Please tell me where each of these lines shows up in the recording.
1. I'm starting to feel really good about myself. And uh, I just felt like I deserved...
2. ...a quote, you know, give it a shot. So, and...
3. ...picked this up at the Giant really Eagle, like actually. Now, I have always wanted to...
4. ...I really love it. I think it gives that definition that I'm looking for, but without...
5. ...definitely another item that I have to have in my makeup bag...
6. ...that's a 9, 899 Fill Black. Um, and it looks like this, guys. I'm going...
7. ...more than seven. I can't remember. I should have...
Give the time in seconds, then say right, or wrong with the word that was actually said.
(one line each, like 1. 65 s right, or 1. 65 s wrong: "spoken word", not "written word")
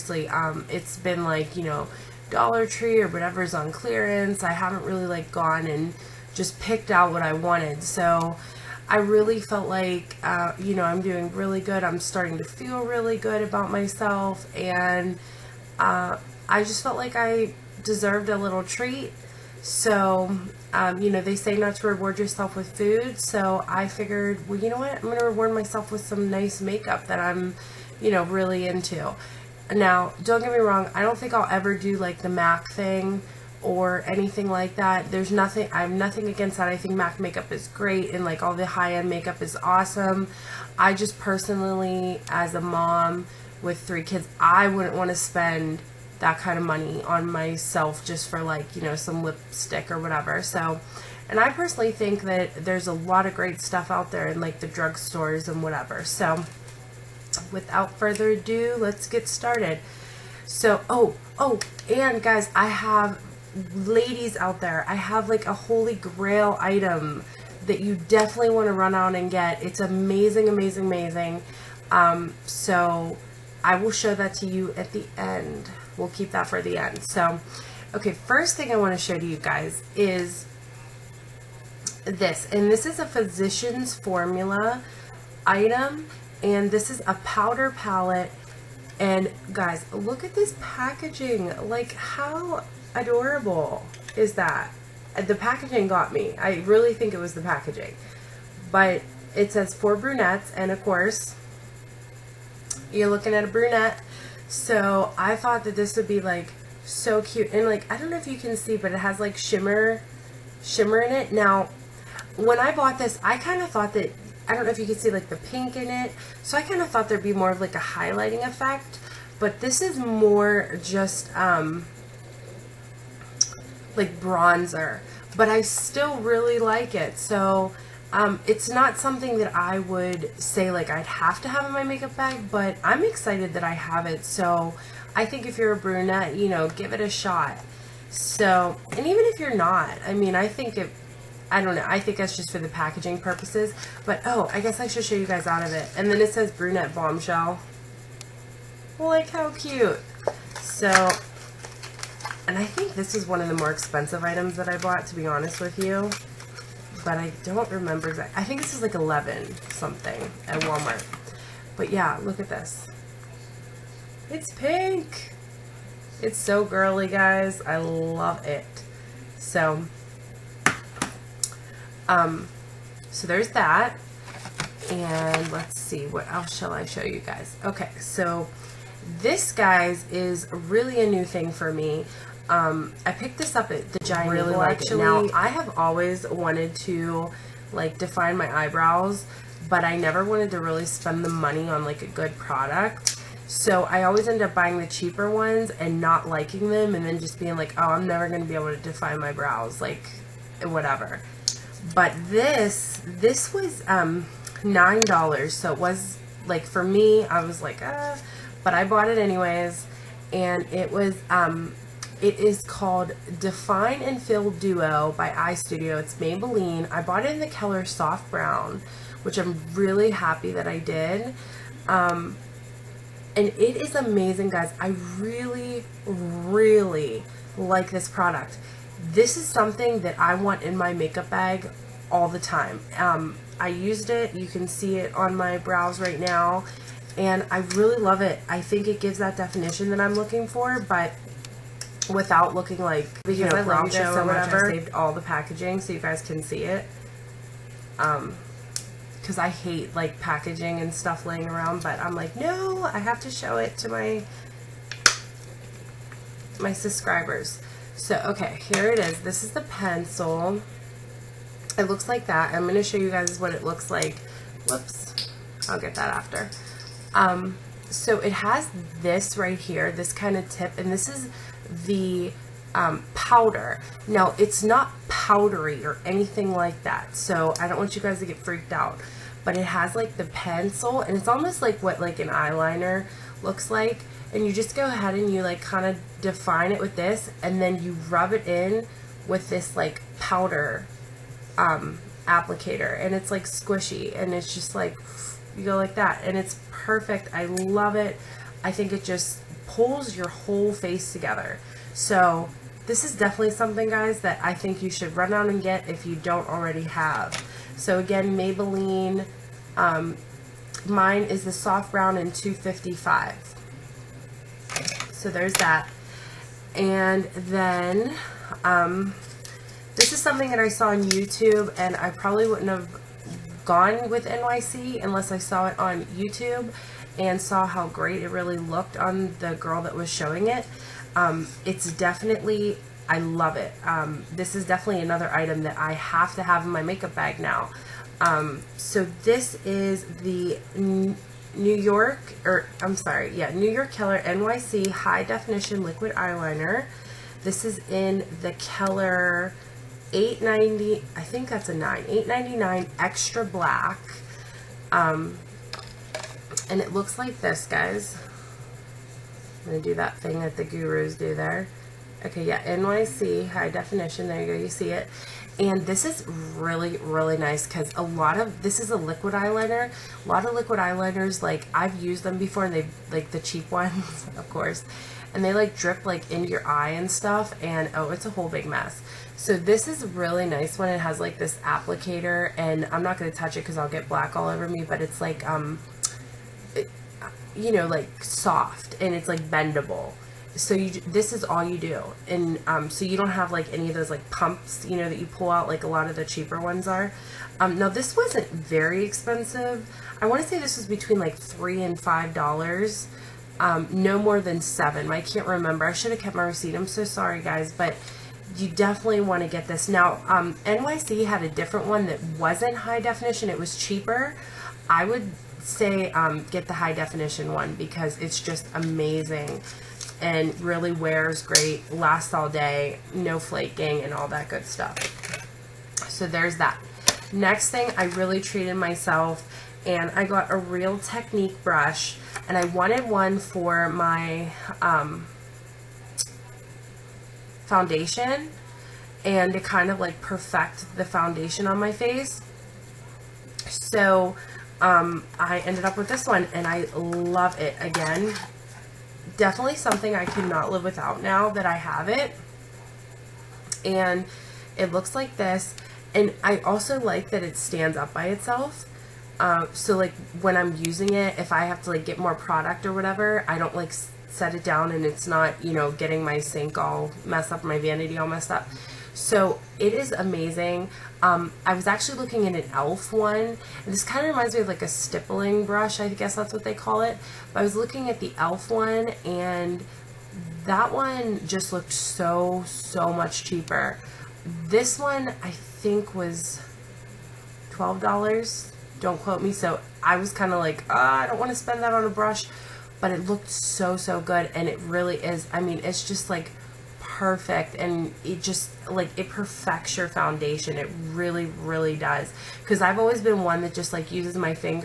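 1. 11 s right
2. 135 s wrong: "brunette", not "quote"
3. 183 s right
4. 237 s right
5. 334 s right
6. 351 s wrong: "Extra", not "Fill"
7. 404 s right.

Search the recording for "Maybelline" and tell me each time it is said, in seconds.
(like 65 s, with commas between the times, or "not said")
216 s, 308 s.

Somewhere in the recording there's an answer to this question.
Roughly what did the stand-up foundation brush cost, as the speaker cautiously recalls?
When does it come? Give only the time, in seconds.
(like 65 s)
487 s.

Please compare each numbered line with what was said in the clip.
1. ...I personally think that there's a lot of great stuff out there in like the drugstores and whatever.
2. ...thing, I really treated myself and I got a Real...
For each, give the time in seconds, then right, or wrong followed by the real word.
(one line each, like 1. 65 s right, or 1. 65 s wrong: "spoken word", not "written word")
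1. 51 s right
2. 427 s right.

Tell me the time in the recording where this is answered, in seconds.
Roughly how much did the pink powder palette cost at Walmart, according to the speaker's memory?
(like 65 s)
158 s.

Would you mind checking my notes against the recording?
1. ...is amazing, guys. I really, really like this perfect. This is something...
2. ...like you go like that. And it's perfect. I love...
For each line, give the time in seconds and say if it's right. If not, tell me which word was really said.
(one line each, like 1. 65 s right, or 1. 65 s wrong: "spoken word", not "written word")
1. 223 s wrong: "product", not "perfect"
2. 294 s right.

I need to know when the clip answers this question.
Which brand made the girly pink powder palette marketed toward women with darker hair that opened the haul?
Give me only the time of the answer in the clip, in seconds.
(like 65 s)
83 s.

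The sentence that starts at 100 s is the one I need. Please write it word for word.
And of course, you're looking at a brunette so I thought that this would be like so cute.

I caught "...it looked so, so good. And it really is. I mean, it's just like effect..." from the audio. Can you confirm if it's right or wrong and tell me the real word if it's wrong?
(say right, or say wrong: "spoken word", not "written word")
wrong: "perfect", not "effect".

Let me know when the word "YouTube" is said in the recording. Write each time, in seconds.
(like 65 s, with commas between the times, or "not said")
321 s, 326 s.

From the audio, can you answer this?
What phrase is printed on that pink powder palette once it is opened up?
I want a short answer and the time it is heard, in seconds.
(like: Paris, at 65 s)
brunette bombshell, at 146 s.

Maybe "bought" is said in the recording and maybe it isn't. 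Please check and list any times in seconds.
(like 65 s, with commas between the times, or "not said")
112 s, 154 s, 208 s, 217 s.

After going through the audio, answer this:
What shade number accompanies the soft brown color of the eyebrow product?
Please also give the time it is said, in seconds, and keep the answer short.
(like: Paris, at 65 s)
255, at 312 s.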